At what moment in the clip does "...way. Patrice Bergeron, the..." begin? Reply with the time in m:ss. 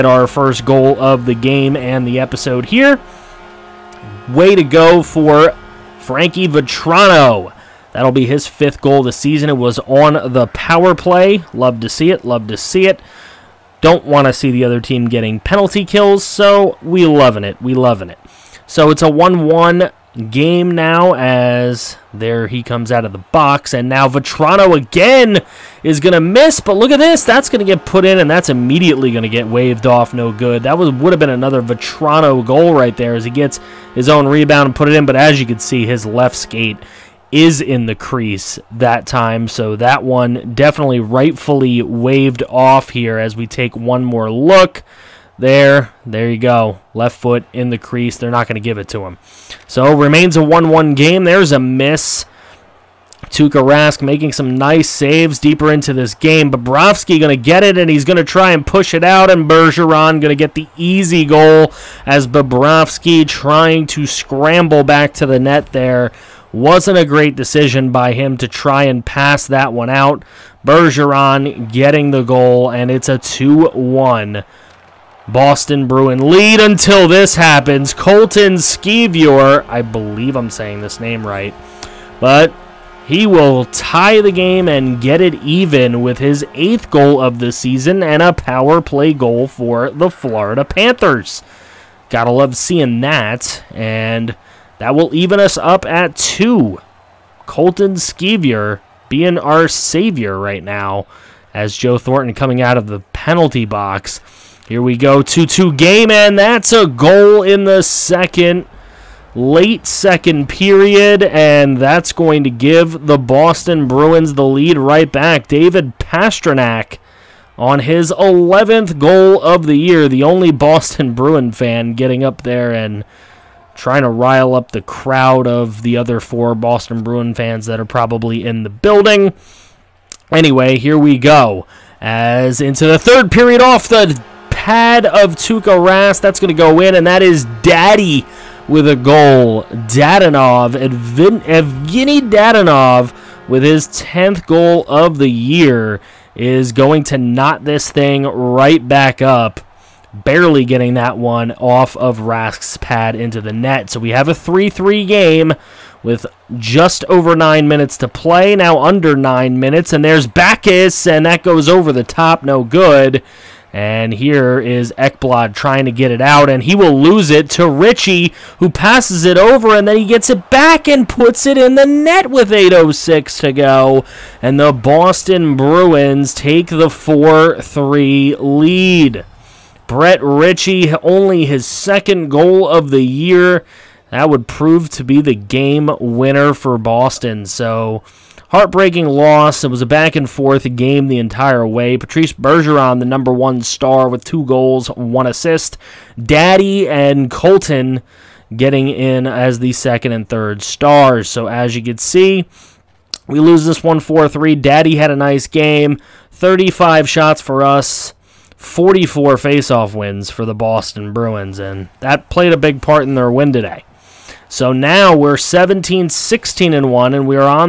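3:11.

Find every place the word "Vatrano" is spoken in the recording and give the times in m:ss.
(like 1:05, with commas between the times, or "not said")
0:06, 0:24, 0:31.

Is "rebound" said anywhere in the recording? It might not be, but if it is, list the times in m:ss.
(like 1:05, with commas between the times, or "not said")
0:34.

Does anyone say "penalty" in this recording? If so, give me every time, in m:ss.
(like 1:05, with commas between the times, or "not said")
0:15, 1:43.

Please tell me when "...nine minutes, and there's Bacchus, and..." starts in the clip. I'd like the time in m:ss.
2:39.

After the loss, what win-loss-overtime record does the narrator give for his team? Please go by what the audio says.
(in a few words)
17-16-1.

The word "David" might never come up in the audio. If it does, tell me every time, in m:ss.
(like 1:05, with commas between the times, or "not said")
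1:55.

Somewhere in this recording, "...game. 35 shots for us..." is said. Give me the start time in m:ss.
3:25.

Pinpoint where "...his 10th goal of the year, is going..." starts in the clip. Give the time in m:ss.
2:23.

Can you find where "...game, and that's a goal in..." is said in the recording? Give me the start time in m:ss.
1:45.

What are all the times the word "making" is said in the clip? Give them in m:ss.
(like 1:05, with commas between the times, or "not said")
0:54.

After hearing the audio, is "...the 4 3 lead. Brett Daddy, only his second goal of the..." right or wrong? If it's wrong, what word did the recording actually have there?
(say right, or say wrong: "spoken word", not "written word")
wrong: "Ritchie", not "Daddy".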